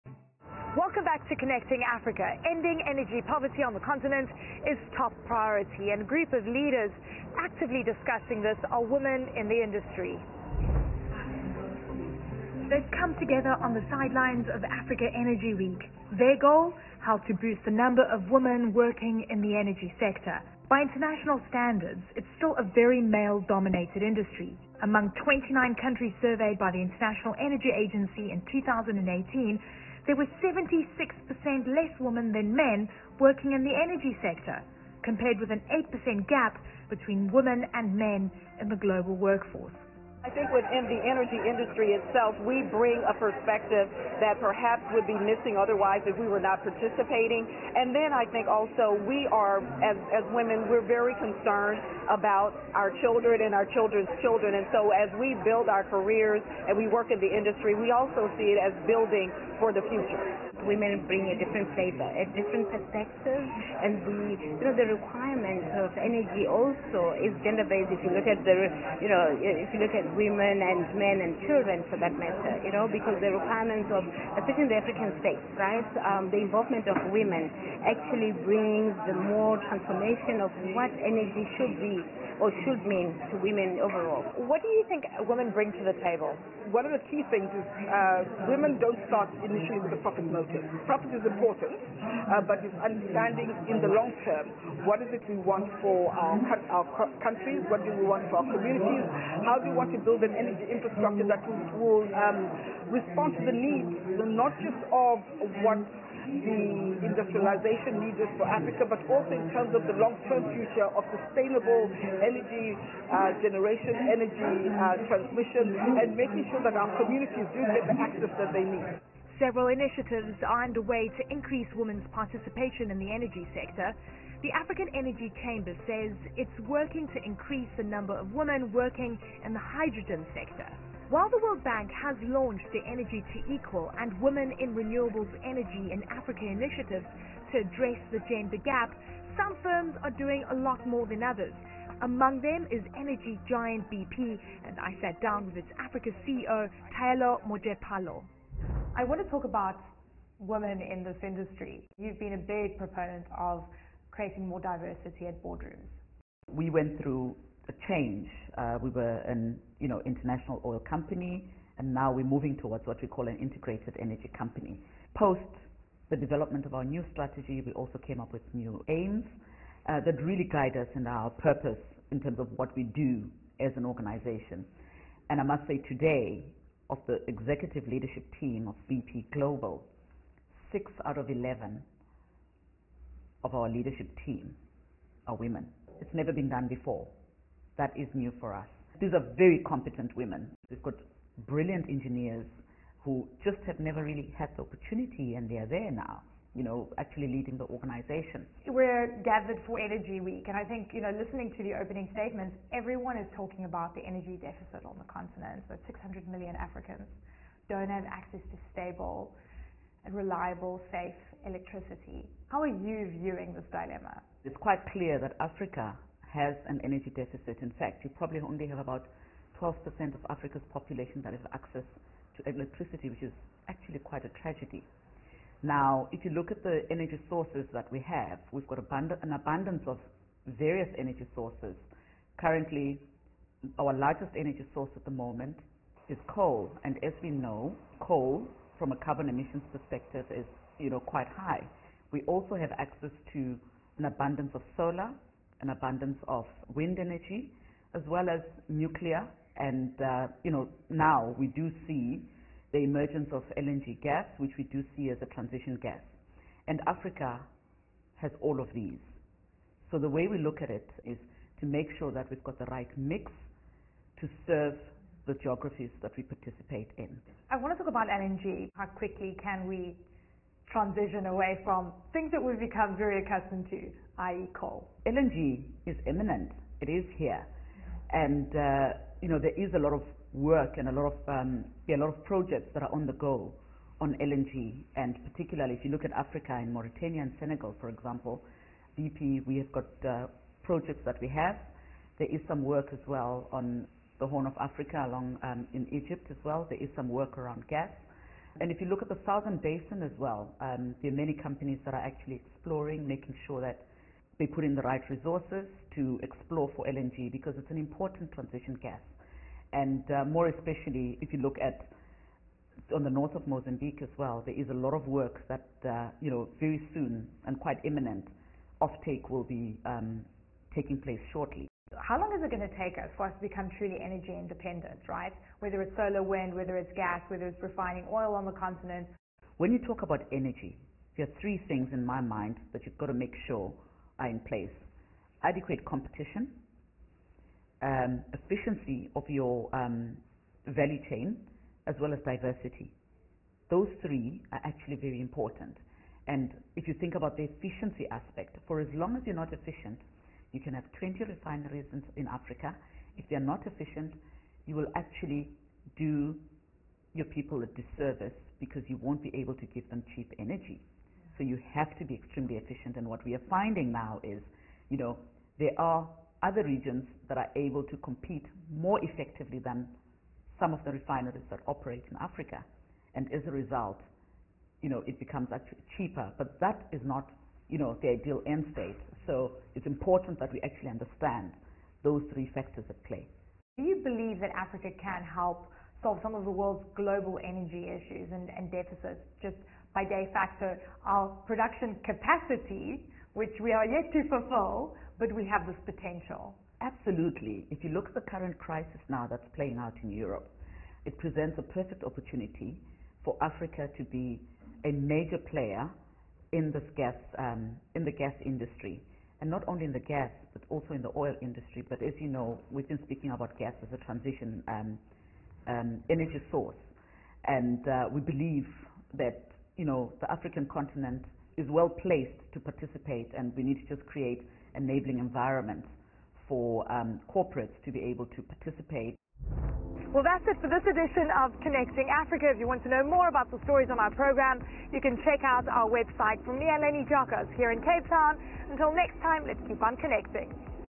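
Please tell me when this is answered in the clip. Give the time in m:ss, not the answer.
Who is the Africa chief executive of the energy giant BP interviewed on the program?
2:26.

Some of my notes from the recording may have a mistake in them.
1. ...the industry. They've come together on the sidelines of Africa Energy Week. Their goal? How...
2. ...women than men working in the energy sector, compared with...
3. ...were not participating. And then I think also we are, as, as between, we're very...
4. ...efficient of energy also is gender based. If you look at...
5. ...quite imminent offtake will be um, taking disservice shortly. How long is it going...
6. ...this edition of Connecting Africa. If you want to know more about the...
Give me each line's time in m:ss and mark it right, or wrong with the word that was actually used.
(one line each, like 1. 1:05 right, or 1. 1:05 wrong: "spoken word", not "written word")
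1. 0:09 right
2. 0:31 right
3. 0:46 wrong: "women", not "between"
4. 1:04 wrong: "requirement", not "efficient"
5. 5:17 wrong: "place", not "disservice"
6. 7:10 right.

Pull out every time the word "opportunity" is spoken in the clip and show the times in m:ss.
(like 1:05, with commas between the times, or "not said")
3:14, 6:42.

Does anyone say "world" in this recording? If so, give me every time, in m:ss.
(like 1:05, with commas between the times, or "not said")
2:11, 6:26.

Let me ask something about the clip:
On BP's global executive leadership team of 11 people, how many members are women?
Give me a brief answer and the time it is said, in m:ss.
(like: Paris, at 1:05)
6, at 3:00.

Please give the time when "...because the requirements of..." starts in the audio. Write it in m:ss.
1:12.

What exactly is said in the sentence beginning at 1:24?
What do you think women bring to the table?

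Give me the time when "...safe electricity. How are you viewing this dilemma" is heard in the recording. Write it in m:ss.
3:30.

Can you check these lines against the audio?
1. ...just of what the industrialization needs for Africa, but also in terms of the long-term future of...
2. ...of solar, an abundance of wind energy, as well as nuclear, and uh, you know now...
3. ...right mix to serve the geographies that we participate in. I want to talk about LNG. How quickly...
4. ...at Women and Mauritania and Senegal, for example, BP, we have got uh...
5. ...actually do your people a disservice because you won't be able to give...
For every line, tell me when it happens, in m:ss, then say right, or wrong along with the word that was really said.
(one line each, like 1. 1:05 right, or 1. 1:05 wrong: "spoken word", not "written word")
1. 1:44 right
2. 4:04 right
3. 4:22 right
4. 4:46 wrong: "Africa", not "Women"
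5. 5:54 right.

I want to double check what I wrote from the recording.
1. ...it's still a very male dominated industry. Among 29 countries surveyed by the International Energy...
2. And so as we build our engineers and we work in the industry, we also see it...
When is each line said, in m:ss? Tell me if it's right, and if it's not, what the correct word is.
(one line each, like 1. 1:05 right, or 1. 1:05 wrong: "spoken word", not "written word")
1. 0:22 right
2. 0:54 wrong: "careers", not "engineers".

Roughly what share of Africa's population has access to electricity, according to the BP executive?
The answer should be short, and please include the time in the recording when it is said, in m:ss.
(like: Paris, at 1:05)
12%, at 3:39.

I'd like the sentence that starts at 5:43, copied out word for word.
Those three are actually very important.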